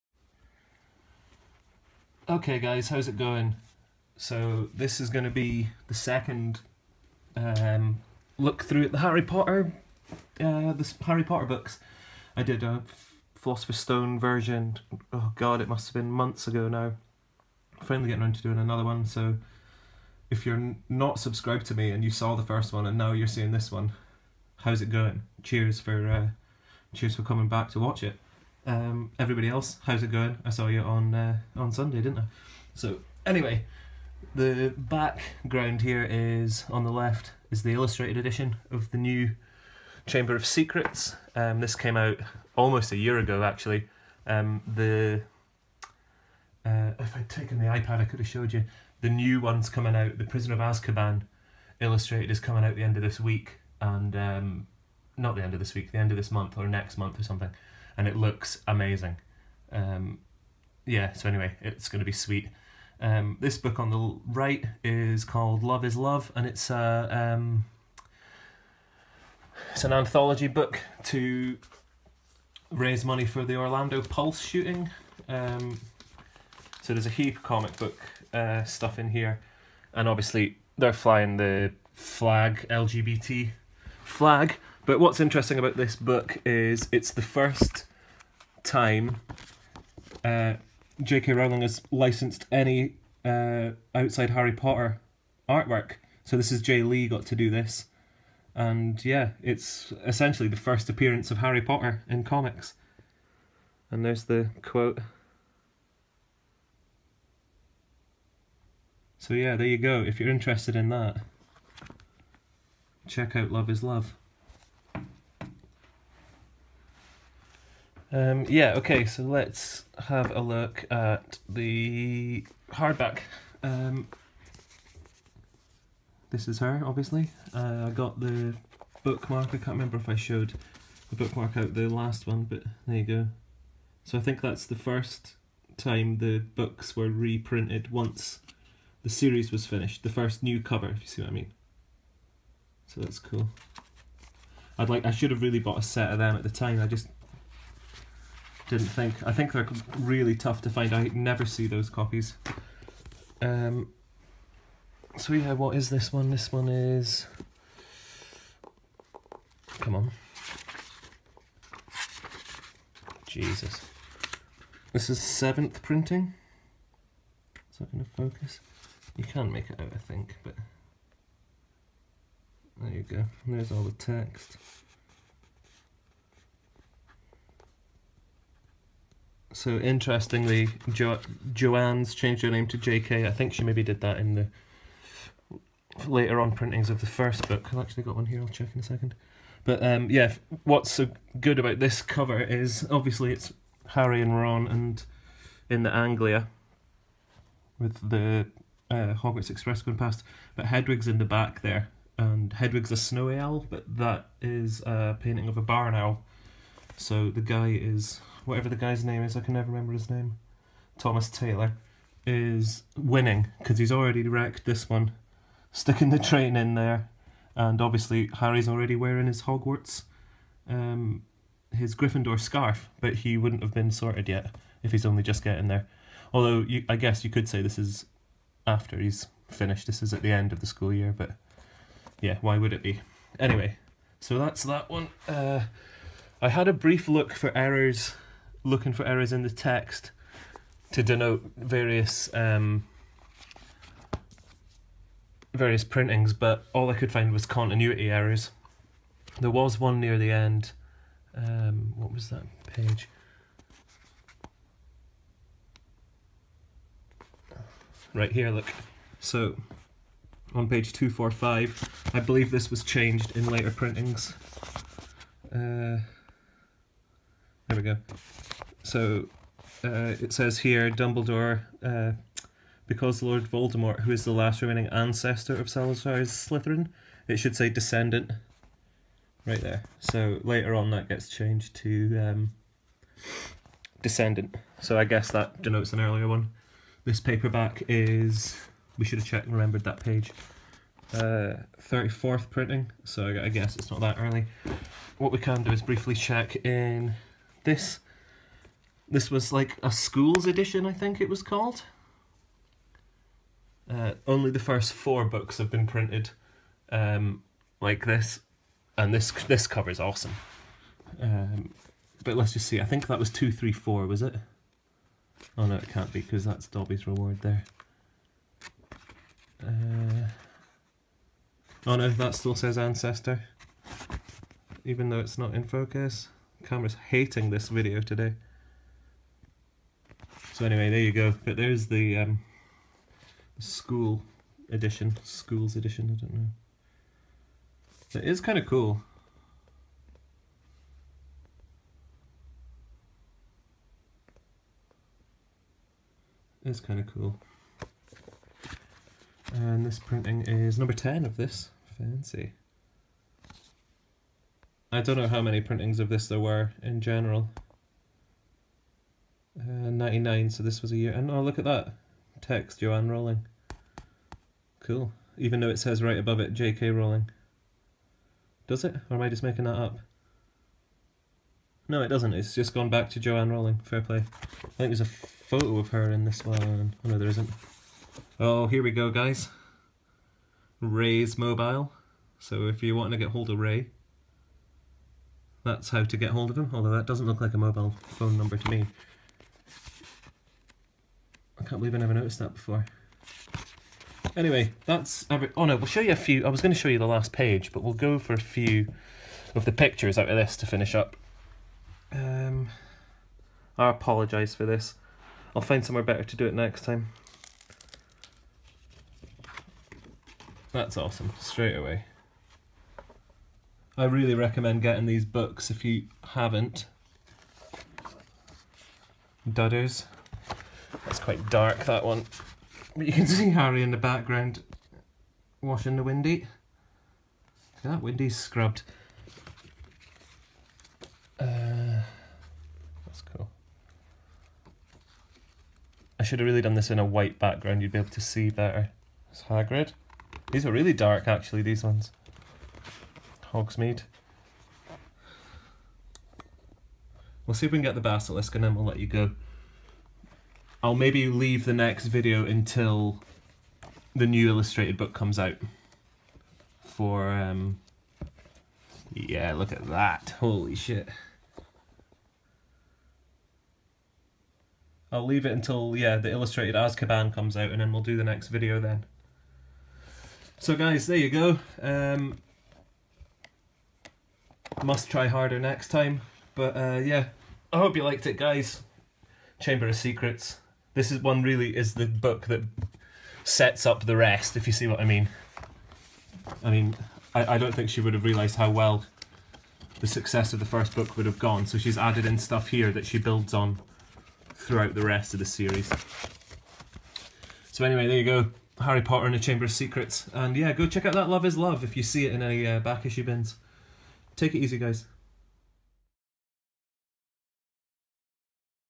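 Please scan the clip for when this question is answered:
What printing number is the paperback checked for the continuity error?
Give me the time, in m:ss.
4:51.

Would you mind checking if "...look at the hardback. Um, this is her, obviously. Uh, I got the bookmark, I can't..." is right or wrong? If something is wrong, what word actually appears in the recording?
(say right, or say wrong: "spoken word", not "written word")
right.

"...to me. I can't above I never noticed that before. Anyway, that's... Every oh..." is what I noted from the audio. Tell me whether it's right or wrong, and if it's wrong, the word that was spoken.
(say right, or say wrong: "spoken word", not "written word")
wrong: "believe", not "above".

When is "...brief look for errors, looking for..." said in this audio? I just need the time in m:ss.
3:56.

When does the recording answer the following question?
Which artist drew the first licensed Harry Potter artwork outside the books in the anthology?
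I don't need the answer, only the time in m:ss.
1:36.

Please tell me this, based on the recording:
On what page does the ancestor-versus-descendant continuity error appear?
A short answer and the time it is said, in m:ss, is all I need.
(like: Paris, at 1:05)
245, at 4:20.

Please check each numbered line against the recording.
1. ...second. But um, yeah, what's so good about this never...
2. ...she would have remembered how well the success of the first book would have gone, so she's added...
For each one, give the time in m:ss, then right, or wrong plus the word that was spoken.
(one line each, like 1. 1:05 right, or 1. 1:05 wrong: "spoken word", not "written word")
1. 3:08 wrong: "cover", not "never"
2. 8:07 wrong: "realised", not "remembered".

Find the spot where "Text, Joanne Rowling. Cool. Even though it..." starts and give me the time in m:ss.
6:02.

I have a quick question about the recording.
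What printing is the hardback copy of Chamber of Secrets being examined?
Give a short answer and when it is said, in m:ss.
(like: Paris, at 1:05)
Seventh, at 2:45.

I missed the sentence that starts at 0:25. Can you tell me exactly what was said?
Cheers for, uh, cheers for coming back to watch it.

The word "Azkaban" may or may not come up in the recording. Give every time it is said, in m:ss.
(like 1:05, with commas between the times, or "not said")
0:50, 7:46.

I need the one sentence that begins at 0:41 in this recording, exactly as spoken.
Um, this came out almost a year ago, actually.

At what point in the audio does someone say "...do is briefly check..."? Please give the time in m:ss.
4:55.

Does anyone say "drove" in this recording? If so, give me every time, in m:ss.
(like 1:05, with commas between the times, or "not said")
not said.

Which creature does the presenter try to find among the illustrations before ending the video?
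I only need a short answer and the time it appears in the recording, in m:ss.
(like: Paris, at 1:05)
Basilisk, at 7:28.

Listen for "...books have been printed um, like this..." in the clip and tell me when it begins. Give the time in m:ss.
5:05.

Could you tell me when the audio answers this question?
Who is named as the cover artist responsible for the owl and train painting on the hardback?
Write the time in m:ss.
3:30.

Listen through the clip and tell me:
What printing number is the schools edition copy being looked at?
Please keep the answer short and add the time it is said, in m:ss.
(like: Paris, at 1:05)
10, at 5:50.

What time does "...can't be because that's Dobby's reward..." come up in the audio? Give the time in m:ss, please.
5:15.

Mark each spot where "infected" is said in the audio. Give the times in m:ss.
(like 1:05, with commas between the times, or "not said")
not said.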